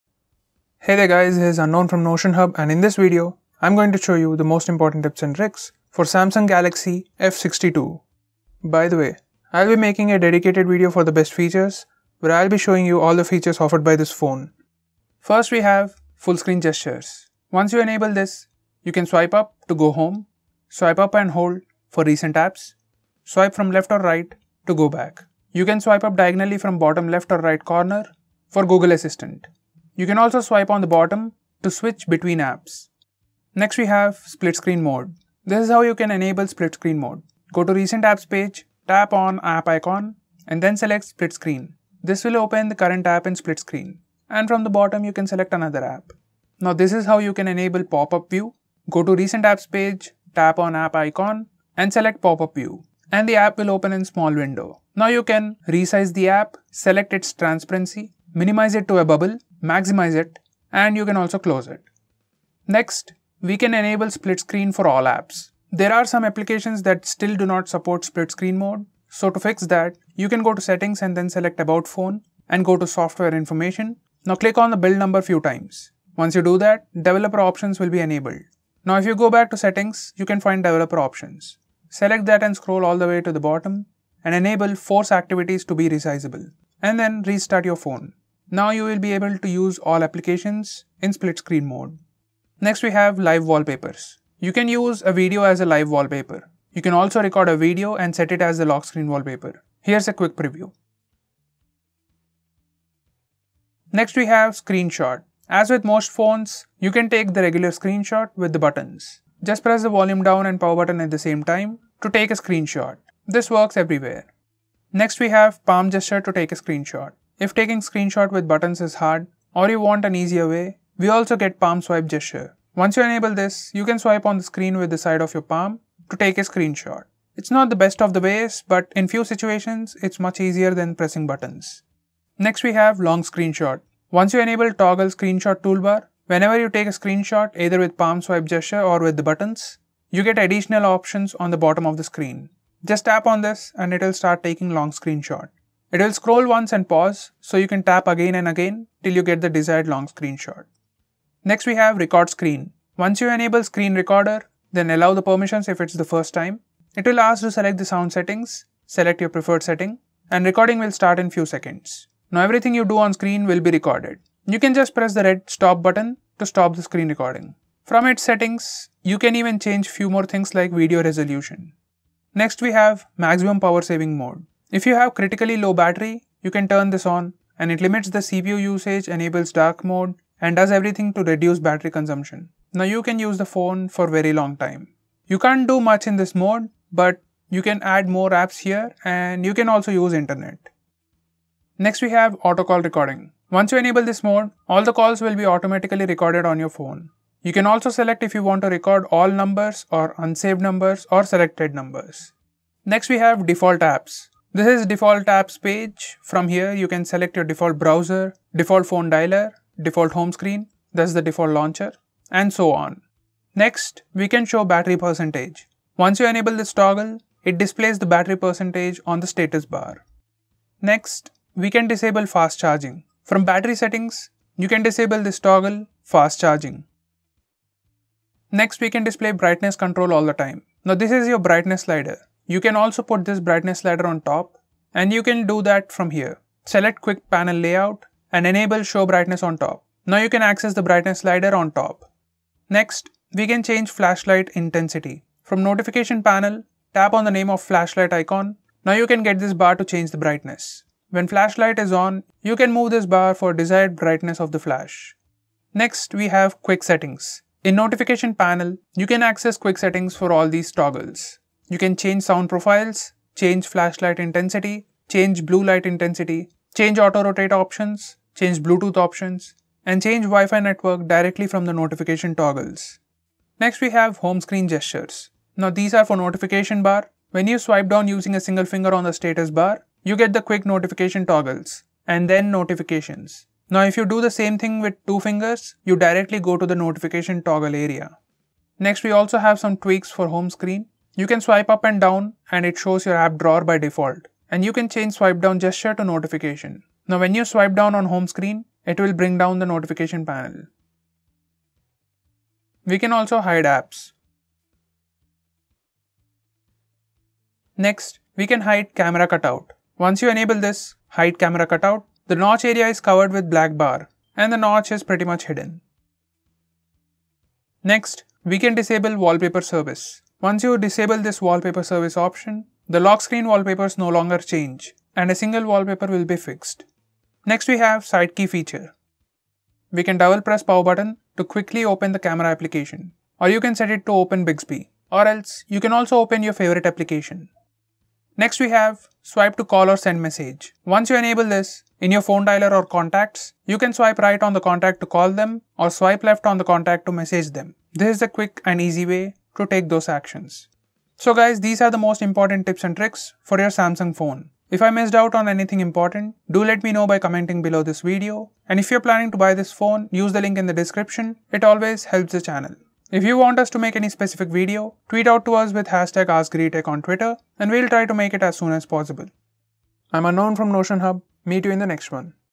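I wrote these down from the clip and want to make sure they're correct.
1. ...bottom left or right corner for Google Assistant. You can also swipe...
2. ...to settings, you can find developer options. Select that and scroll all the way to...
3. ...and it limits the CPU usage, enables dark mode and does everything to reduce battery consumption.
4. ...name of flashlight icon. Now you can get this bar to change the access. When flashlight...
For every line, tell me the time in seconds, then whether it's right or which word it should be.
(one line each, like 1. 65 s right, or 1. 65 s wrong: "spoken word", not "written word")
1. 26 s right
2. 79 s right
3. 177 s right
4. 247 s wrong: "brightness", not "access".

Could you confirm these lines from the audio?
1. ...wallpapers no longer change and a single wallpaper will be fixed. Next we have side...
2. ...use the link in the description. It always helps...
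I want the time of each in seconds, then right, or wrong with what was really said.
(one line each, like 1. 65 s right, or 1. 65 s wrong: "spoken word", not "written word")
1. 323 s right
2. 360 s right.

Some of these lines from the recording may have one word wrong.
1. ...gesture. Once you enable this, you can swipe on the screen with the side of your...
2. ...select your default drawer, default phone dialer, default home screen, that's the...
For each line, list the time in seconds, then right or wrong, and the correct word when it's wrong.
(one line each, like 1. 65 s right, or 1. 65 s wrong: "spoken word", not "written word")
1. 122 s right
2. 207 s wrong: "browser", not "drawer".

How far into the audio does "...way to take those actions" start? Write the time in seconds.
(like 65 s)
349 s.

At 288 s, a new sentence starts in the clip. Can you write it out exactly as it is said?
Next we also have some tweaks for home screen.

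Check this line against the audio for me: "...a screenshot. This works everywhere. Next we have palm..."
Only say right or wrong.
right.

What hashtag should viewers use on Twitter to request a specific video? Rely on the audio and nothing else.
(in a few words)
AskGreedyTech.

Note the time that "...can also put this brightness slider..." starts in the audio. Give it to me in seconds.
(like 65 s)
232 s.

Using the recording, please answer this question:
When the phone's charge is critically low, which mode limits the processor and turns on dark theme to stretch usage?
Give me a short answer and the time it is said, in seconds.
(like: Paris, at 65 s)
maximum power saving mode, at 173 s.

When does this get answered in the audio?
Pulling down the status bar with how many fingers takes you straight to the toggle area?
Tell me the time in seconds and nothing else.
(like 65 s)
285 s.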